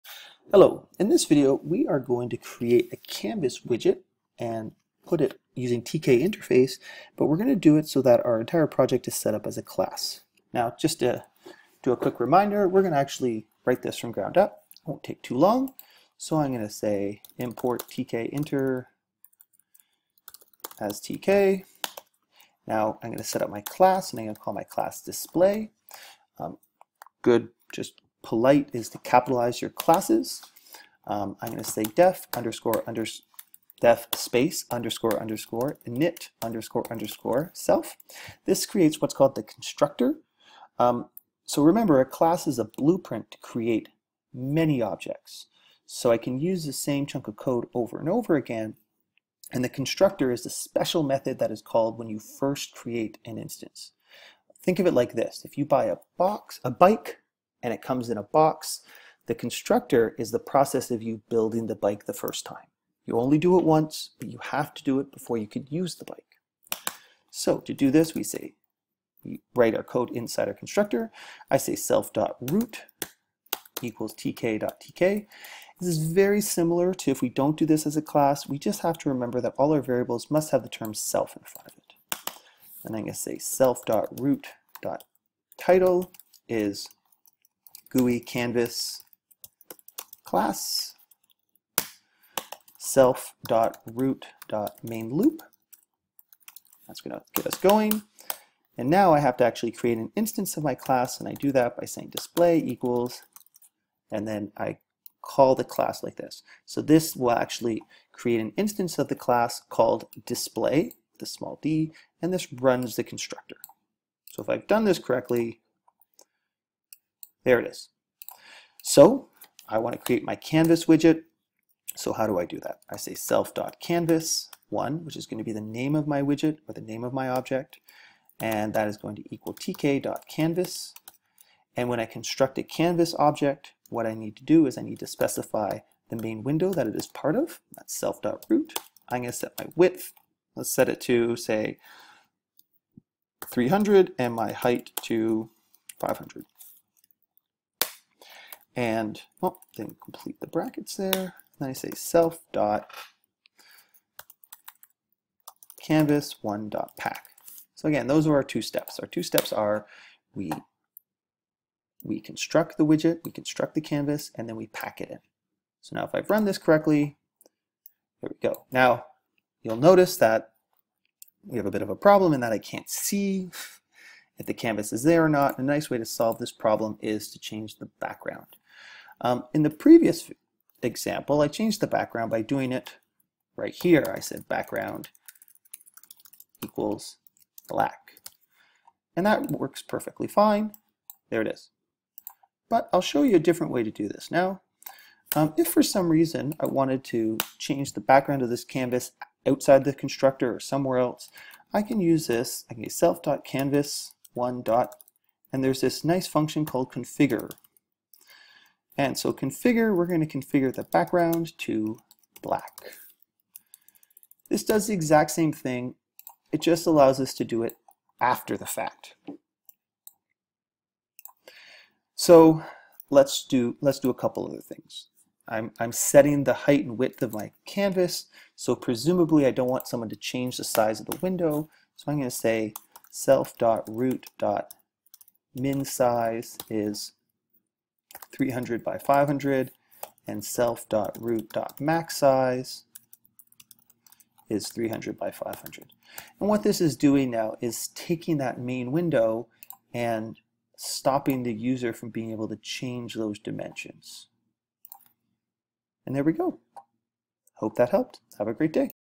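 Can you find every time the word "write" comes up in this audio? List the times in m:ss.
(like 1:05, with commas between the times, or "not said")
0:13, 1:09.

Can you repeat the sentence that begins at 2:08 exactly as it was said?
And that is going to equal tk.canvas.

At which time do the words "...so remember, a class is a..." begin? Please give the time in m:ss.
0:41.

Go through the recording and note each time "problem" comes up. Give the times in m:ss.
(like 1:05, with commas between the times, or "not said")
2:51, 2:56.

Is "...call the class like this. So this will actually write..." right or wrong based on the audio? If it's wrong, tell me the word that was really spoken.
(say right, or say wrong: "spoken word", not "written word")
wrong: "create", not "write".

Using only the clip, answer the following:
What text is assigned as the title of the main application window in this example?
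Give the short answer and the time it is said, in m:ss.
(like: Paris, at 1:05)
GUI canvas class, at 1:27.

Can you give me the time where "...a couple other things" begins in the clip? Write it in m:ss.
3:44.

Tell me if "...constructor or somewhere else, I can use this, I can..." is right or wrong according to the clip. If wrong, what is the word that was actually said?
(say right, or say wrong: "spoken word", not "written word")
right.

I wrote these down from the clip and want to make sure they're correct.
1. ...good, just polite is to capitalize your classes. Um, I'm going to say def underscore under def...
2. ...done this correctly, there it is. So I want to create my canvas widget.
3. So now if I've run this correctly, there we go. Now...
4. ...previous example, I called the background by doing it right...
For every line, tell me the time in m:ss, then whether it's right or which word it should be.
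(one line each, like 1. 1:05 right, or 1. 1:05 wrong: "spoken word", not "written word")
1. 0:27 right
2. 1:54 right
3. 2:45 right
4. 2:59 wrong: "changed", not "called".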